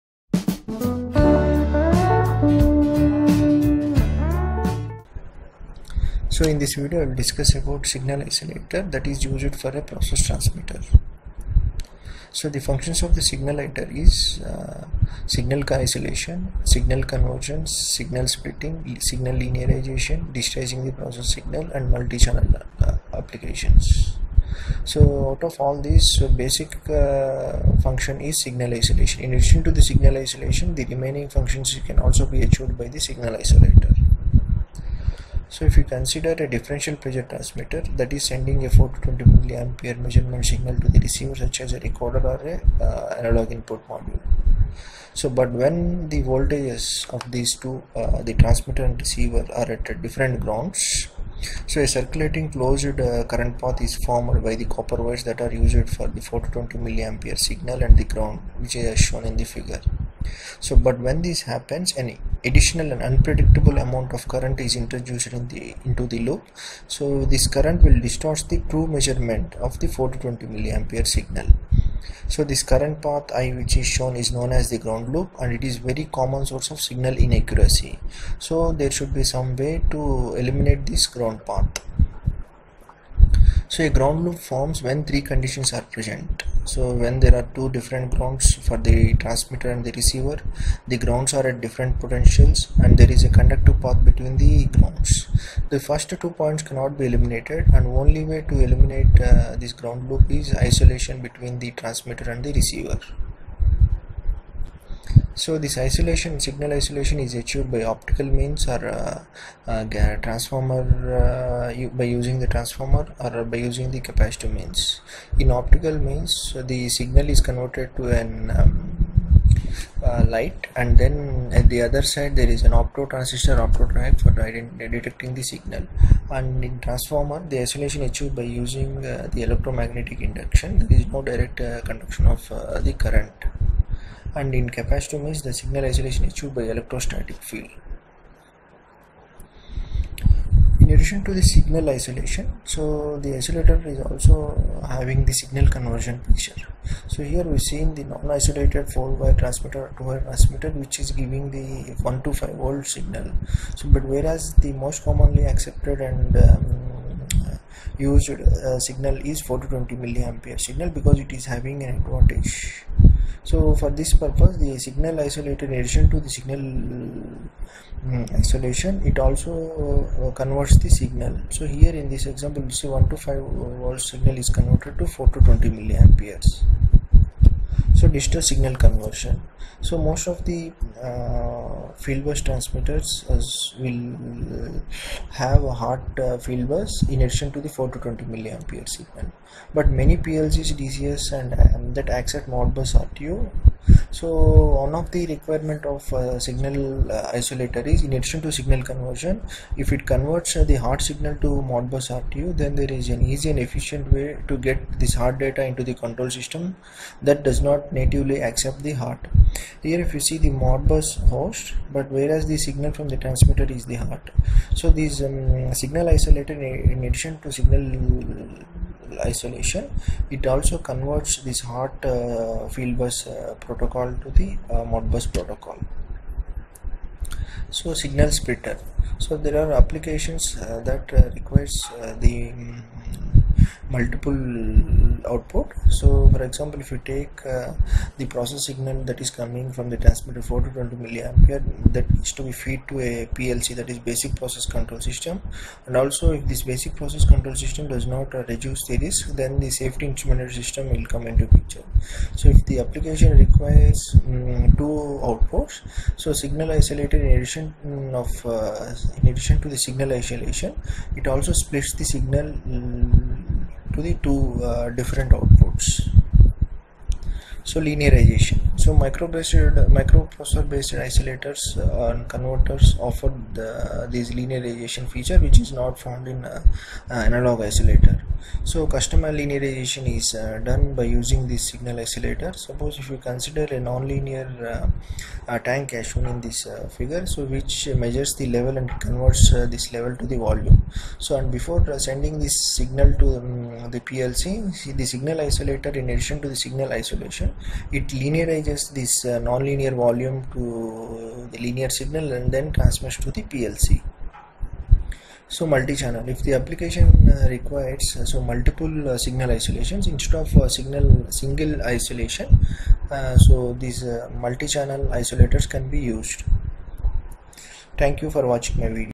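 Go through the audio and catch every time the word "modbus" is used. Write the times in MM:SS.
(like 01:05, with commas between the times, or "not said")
03:12, 03:21, 03:30, 03:44.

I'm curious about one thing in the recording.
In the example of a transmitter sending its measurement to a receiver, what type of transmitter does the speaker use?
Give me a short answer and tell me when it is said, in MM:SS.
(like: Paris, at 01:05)
Differential pressure transmitter, at 00:36.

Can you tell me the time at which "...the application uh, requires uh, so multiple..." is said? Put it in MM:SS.
05:06.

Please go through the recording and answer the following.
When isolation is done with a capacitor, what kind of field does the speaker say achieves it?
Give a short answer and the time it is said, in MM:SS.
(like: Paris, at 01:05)
Electrostatic field, at 02:16.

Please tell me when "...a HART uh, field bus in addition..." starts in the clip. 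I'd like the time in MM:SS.
03:05.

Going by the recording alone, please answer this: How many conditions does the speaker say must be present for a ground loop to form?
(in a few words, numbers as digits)
3.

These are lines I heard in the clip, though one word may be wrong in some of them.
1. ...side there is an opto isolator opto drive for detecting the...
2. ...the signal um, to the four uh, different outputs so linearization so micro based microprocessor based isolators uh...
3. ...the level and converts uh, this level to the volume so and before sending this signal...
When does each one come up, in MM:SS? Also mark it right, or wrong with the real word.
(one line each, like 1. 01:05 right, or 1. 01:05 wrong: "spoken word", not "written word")
1. 02:02 wrong: "transistor", not "isolator"
2. 04:21 wrong: "two", not "four"
3. 04:48 right.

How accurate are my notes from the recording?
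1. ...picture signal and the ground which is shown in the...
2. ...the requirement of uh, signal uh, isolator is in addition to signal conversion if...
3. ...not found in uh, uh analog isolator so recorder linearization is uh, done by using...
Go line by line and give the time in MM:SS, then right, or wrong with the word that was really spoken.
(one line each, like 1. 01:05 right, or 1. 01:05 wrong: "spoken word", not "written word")
1. 00:56 wrong: "milliampere", not "picture"
2. 03:15 right
3. 04:35 wrong: "customer", not "recorder".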